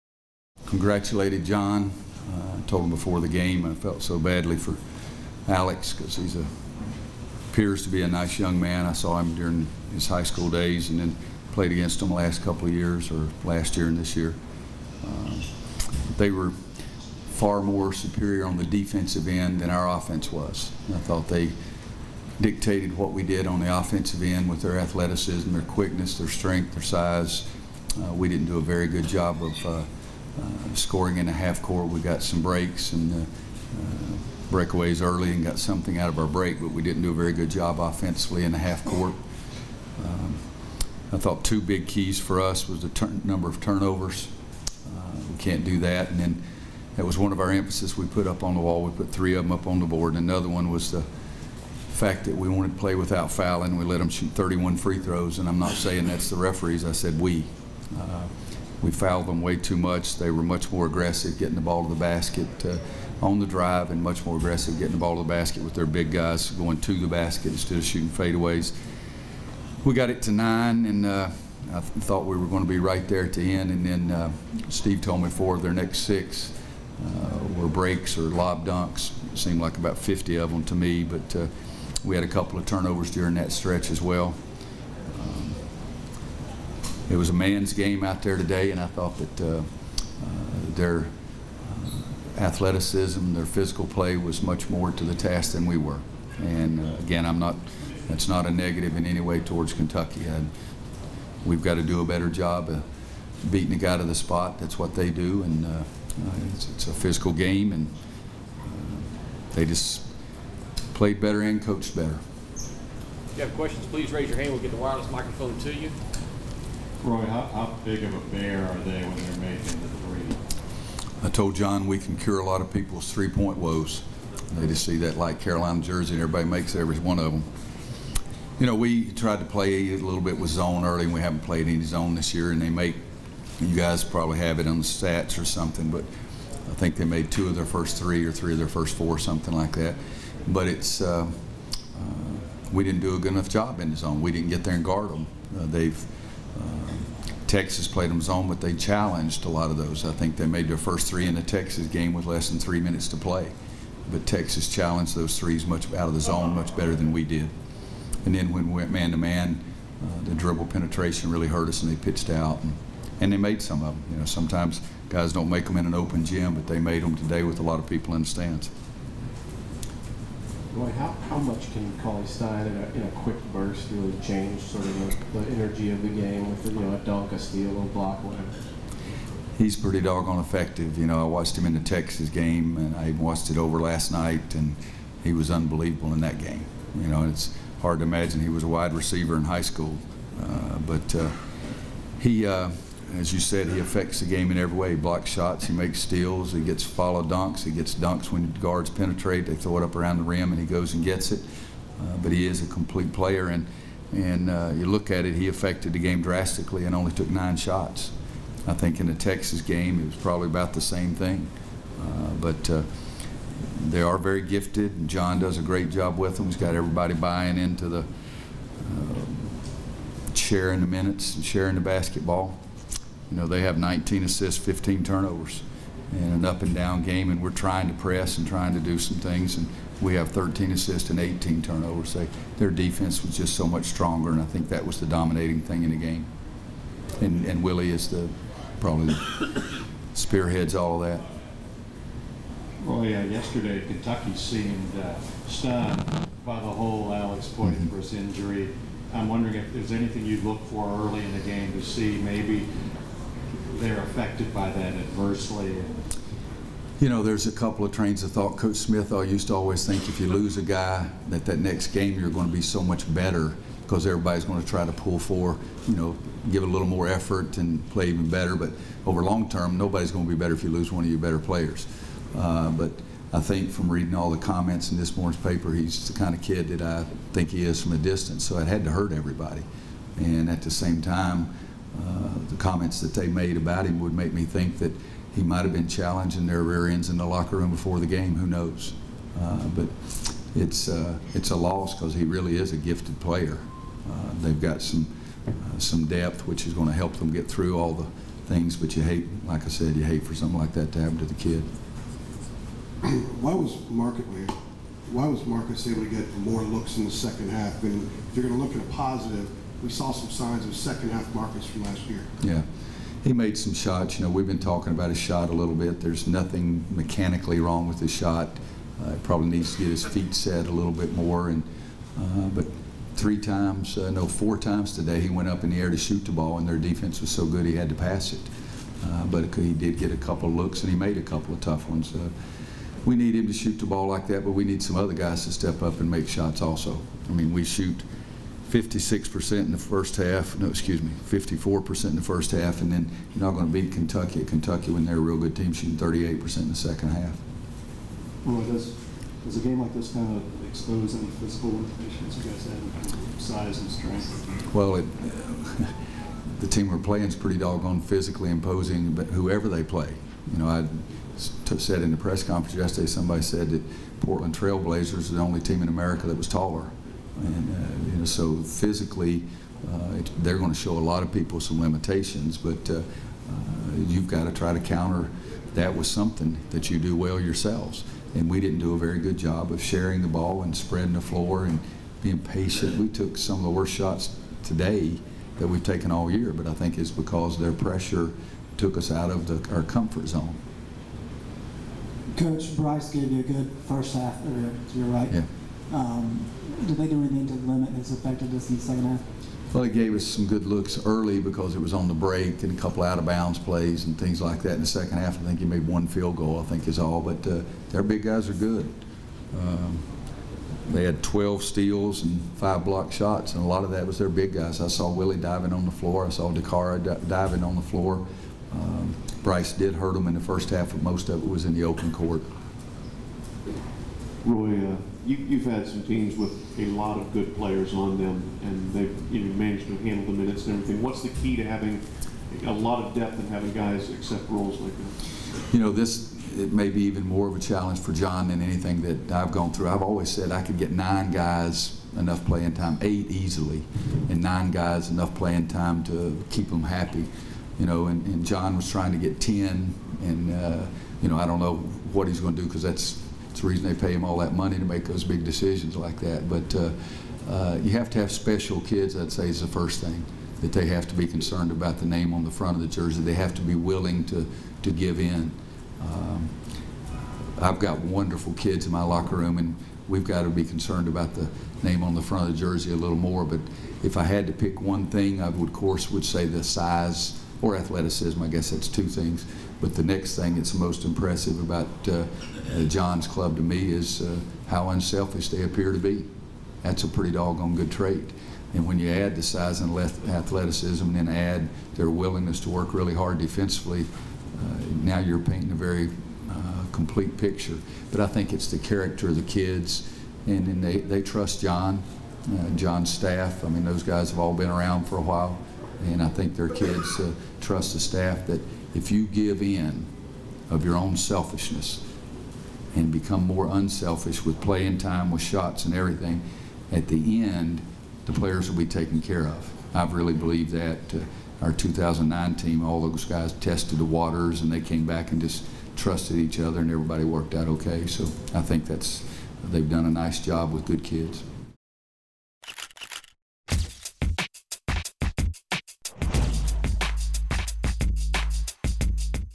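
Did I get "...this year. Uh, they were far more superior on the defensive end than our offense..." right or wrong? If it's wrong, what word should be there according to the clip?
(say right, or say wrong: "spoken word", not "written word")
right.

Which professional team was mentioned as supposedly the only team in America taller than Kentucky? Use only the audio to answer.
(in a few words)
Portland Trailblazers.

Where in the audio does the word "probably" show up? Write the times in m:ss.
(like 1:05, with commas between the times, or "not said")
2:14, 3:30, 3:58, 5:19.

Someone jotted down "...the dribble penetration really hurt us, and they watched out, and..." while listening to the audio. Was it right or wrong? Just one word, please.
wrong.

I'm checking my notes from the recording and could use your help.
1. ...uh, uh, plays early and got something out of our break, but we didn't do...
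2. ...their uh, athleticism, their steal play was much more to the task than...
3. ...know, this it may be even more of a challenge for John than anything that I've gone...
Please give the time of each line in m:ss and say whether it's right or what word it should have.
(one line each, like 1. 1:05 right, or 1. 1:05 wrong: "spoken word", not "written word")
1. 0:33 wrong: "breakaways", not "plays"
2. 1:30 wrong: "physical", not "steal"
3. 7:15 right.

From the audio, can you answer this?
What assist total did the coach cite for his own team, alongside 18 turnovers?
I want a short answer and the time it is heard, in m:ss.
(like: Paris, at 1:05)
13, at 3:50.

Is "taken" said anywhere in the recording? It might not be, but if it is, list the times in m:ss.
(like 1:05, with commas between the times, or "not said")
6:25, 8:38.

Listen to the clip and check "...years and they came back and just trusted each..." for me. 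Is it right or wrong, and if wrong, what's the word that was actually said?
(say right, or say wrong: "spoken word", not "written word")
wrong: "waters", not "years".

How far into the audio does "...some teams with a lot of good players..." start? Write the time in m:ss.
7:05.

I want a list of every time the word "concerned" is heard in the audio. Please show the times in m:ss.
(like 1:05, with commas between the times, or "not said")
7:41, 7:50.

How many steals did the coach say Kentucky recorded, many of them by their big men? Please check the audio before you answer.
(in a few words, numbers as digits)
12.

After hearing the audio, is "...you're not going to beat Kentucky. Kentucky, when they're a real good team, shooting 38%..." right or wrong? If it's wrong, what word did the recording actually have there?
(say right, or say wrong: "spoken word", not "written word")
right.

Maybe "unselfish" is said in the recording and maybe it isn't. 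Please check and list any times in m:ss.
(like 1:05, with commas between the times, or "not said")
8:04, 8:33.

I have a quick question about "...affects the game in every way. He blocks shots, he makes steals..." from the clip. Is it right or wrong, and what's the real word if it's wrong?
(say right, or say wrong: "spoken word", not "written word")
right.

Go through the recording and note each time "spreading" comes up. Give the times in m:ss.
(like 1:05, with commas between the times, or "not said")
6:20.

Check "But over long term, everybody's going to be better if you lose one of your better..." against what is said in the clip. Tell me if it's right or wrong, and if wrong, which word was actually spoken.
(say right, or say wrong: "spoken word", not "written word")
wrong: "nobody", not "everybody".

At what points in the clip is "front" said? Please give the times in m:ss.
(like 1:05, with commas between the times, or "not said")
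7:42, 7:52.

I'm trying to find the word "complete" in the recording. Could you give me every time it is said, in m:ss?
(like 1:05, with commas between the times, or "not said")
3:22, 8:16.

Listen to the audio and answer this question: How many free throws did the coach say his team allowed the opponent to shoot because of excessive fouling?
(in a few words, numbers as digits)
31.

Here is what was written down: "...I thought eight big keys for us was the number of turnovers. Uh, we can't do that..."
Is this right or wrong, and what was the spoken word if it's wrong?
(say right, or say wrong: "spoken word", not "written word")
wrong: "two", not "eight".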